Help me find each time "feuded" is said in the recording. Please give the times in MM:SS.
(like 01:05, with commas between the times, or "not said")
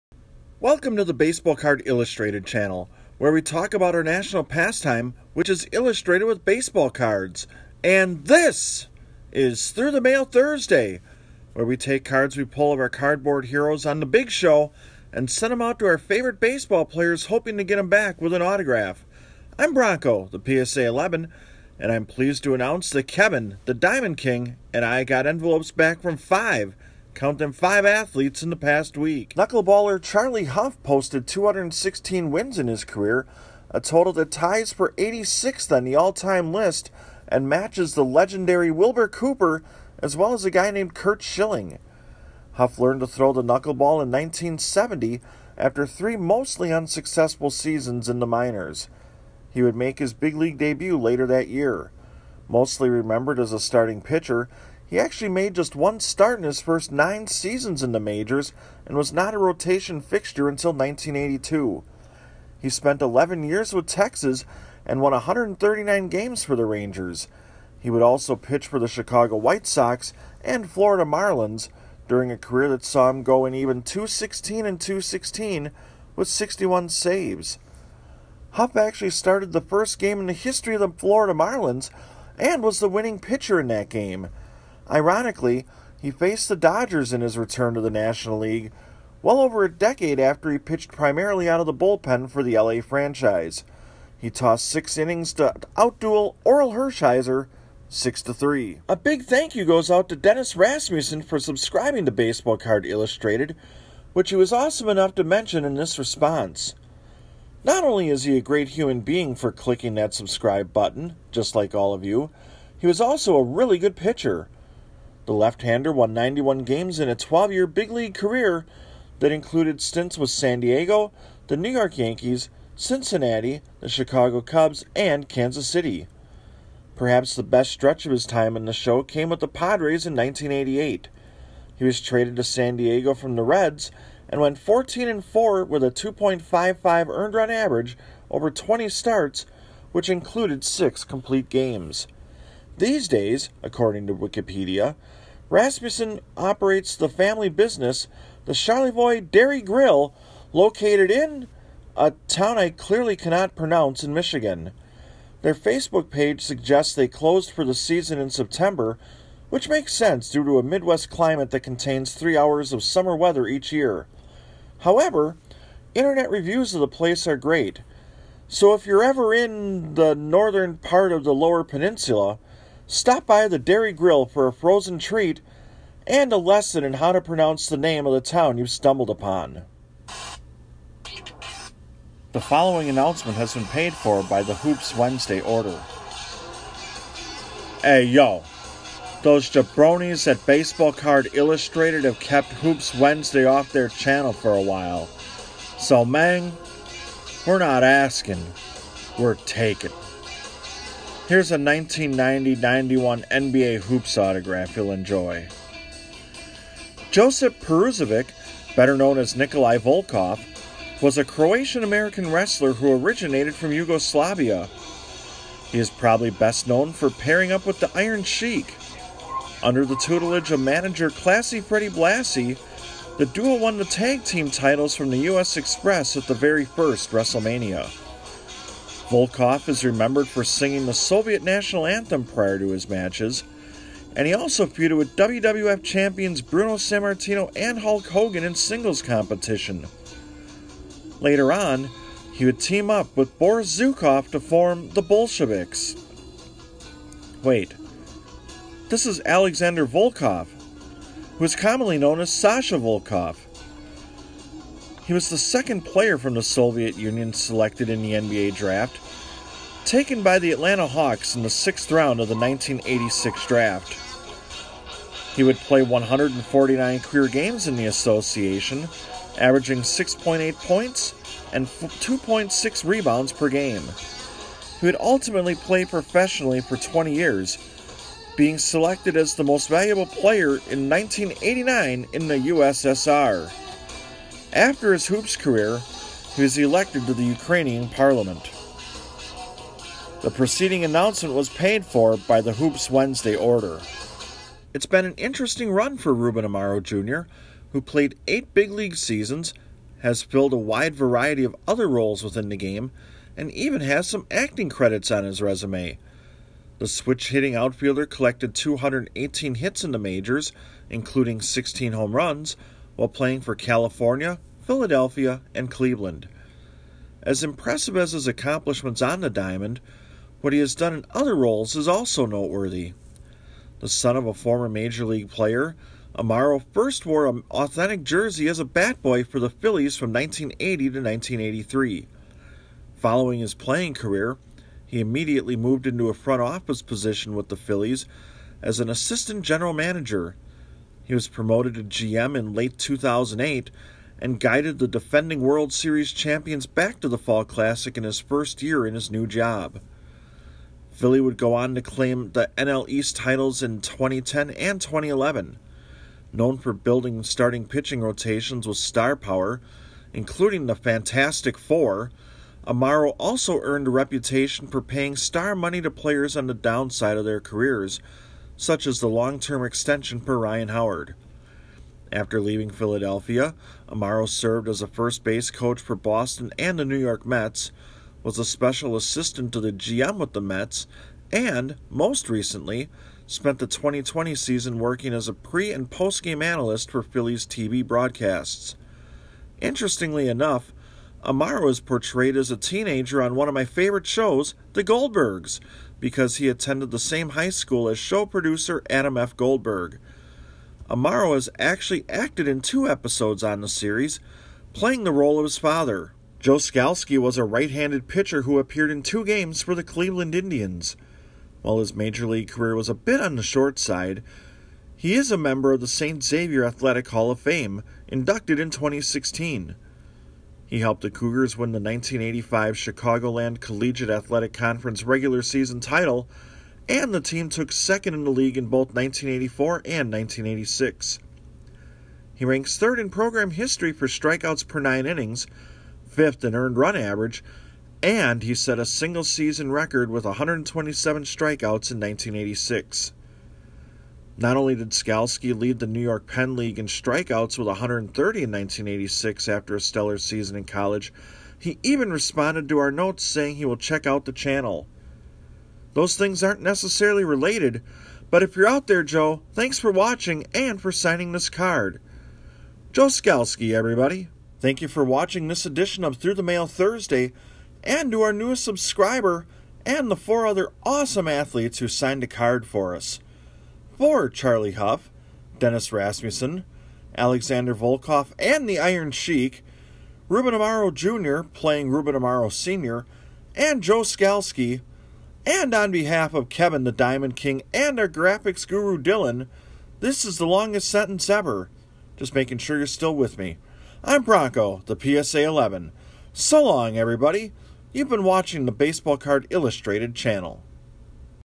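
03:54.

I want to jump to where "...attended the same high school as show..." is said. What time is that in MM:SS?
06:36.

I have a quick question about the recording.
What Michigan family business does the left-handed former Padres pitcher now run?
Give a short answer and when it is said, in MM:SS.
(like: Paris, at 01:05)
Charlevoix Dairy Grill, at 02:28.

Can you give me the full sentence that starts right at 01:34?
He tossed six innings to outduel Orel Hershiser 6 to 3.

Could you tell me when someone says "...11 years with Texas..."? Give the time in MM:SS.
01:03.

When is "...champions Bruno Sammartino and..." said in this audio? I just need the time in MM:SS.
03:55.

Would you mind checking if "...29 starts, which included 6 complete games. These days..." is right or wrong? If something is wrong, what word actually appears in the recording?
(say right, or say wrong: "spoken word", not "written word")
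wrong: "20", not "29".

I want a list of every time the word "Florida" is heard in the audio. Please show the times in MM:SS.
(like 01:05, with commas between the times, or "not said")
01:10, 01:20.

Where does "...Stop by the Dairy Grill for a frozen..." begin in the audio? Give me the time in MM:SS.
02:52.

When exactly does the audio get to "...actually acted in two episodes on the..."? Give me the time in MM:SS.
06:41.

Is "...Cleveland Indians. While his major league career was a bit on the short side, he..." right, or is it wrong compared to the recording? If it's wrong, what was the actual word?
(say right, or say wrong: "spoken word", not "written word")
right.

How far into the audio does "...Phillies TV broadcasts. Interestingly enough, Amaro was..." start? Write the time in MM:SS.
06:27.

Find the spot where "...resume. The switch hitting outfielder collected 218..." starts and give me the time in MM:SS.
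05:05.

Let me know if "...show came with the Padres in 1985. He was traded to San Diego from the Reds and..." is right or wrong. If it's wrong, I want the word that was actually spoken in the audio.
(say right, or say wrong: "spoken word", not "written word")
wrong: "1988", not "1985".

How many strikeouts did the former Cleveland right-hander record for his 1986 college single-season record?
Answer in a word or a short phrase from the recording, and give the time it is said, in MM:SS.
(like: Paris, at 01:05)
127, at 07:20.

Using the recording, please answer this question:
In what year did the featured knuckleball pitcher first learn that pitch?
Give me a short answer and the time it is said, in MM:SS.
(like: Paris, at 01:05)
1970, at 00:44.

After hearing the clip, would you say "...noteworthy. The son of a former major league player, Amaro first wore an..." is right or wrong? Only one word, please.
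right.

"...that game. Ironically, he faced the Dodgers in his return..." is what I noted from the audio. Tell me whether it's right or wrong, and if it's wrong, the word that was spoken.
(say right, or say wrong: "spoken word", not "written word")
right.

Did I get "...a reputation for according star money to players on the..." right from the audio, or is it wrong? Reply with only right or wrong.
wrong.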